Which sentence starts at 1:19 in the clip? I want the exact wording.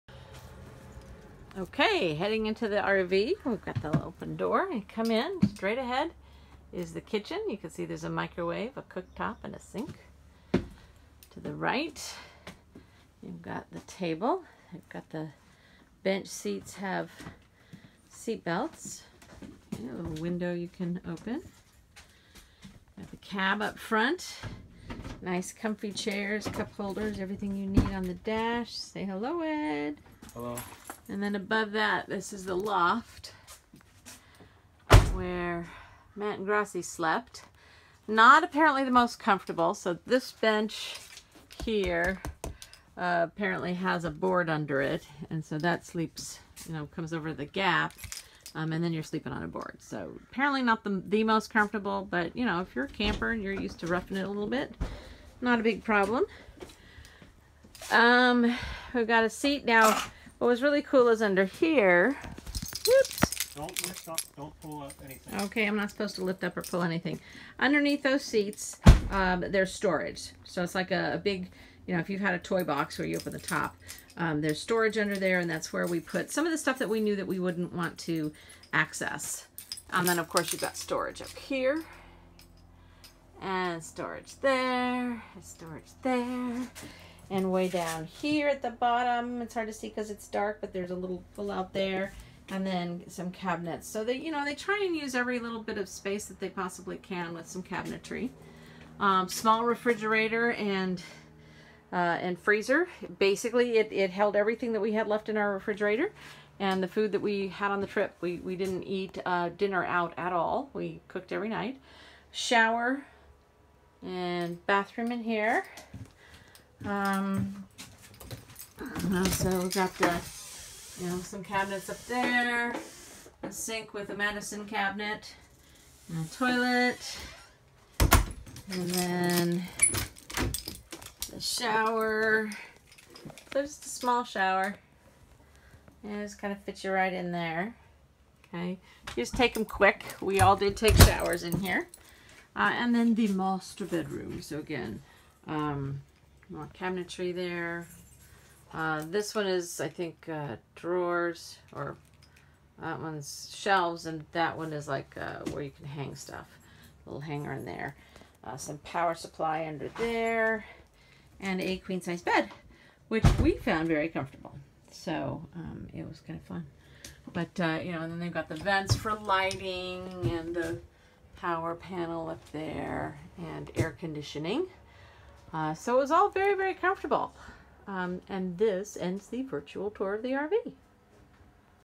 And then, of course, you've got storage up here.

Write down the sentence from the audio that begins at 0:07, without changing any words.
You can see there's a microwave, a cooktop, and a sink.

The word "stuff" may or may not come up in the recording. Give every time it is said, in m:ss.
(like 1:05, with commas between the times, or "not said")
1:16, 2:36.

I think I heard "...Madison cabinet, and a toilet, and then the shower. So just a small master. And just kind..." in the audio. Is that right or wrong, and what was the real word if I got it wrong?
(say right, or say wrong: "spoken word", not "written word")
wrong: "shower", not "master".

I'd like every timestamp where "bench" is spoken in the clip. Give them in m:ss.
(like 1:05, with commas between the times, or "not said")
0:16, 0:40.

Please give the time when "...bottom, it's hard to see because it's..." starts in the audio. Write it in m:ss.
1:28.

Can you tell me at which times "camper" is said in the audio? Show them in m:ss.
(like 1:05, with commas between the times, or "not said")
0:52.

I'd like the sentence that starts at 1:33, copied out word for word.
So they, you know, they try and use every little bit of space that they possibly can with some cabinetry.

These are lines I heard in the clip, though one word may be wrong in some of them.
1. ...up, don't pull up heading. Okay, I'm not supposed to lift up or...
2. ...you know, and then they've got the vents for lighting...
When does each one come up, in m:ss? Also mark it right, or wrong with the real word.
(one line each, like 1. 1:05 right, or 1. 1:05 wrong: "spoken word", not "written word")
1. 1:04 wrong: "anything", not "heading"
2. 2:47 right.